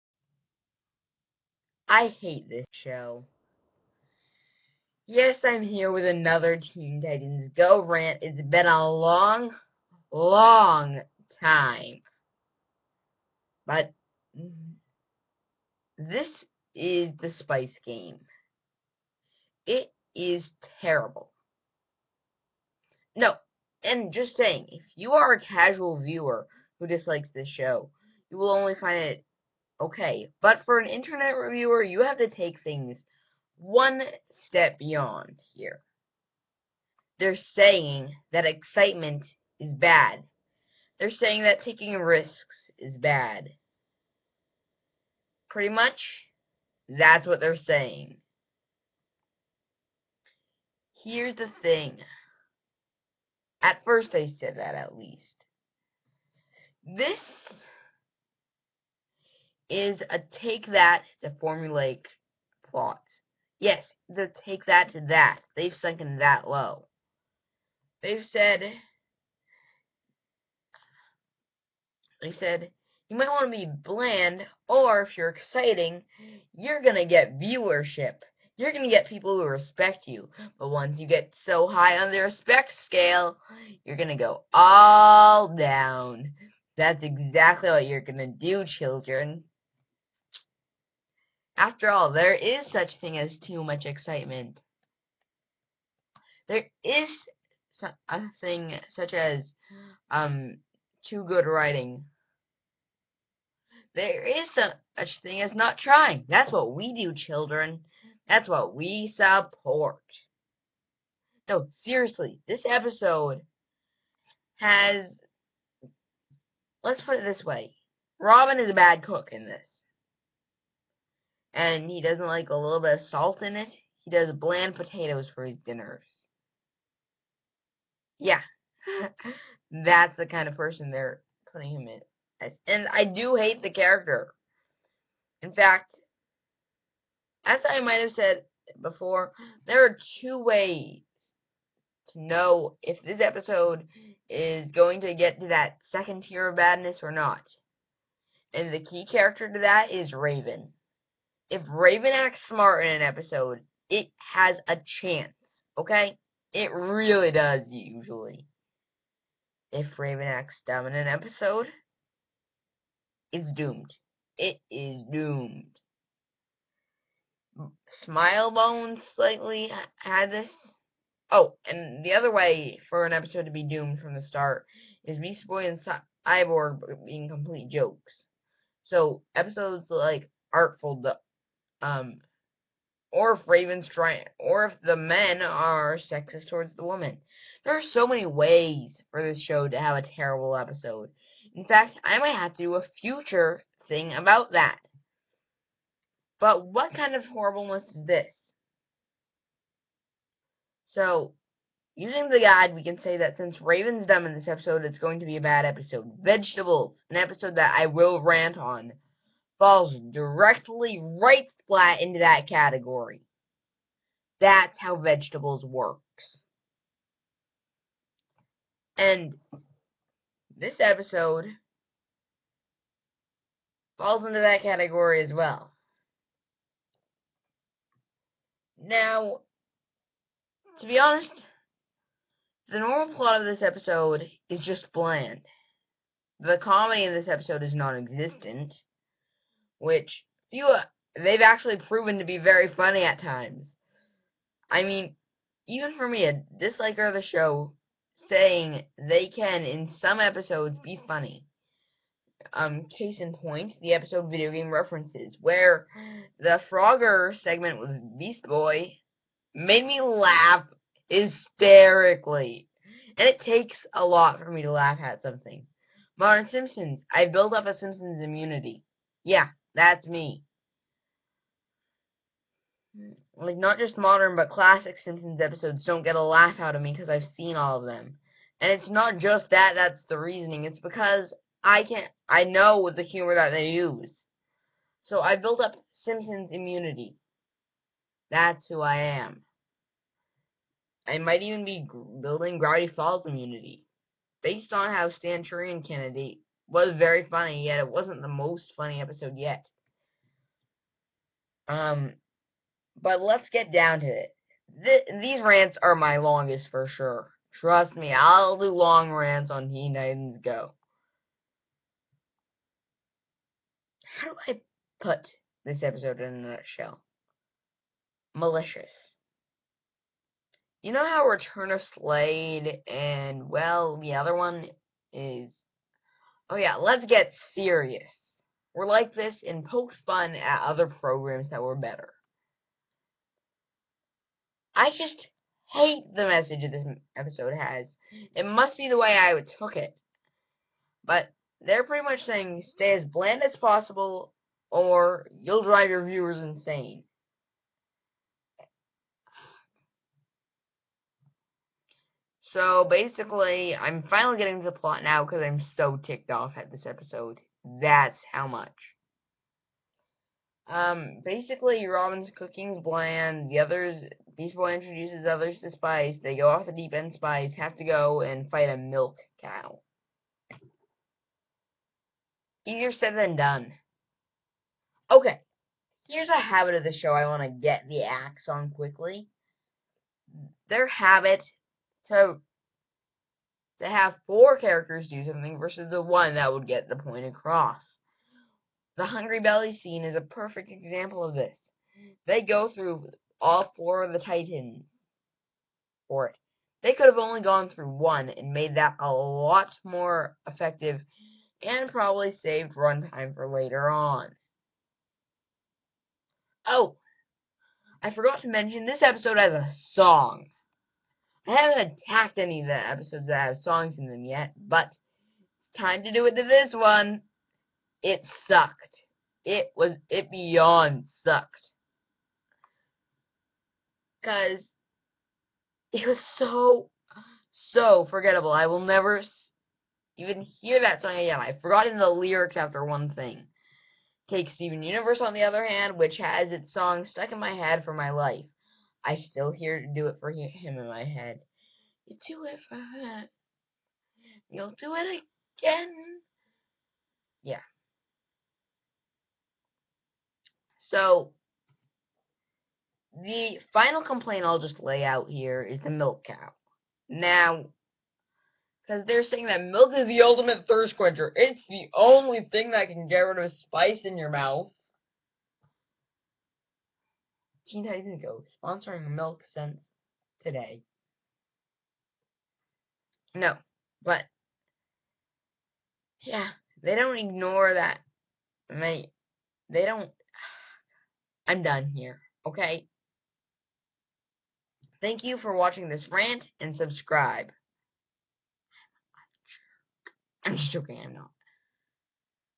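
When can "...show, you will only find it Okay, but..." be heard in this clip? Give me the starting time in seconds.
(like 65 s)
27 s.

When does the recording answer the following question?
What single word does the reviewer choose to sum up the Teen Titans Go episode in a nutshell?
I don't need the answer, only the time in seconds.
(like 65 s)
318 s.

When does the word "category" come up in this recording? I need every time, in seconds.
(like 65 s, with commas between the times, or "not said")
212 s, 224 s.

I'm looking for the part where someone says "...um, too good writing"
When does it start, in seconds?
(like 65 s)
100 s.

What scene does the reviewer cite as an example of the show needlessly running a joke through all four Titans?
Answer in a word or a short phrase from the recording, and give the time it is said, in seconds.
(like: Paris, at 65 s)
The Hungry Belly scene, at 389 s.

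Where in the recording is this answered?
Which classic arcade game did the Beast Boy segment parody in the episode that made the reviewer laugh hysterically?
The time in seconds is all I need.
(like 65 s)
256 s.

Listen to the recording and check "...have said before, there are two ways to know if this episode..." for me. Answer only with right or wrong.
right.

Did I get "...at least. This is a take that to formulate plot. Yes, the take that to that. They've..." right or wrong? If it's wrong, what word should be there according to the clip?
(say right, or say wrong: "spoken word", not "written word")
right.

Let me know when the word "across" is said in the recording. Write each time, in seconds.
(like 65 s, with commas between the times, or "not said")
387 s.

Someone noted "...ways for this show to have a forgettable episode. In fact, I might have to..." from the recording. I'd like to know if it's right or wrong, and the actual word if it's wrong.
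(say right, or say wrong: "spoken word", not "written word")
wrong: "terrible", not "forgettable".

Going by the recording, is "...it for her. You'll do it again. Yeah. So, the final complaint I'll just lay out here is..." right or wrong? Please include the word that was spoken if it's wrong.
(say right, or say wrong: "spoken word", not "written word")
right.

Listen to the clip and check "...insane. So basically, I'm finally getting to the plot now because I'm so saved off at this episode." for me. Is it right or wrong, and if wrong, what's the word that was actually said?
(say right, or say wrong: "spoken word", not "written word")
wrong: "ticked", not "saved".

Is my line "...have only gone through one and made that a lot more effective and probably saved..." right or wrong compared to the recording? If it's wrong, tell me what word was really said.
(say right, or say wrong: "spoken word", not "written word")
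right.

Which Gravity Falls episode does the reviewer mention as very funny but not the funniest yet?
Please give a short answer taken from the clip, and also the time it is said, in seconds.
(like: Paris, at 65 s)
Stanchurian Candidate, at 295 s.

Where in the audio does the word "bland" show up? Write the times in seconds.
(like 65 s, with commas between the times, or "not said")
73 s, 124 s, 234 s, 343 s, 362 s.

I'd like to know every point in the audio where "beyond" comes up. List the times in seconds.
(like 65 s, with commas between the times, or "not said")
34 s, 420 s.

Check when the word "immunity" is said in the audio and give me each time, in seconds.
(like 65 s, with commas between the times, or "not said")
268 s, 286 s, 293 s.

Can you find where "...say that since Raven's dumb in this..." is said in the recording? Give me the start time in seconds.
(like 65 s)
203 s.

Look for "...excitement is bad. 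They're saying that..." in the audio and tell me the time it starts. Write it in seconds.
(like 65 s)
38 s.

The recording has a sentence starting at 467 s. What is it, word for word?
15 days ago sponsoring milk since today.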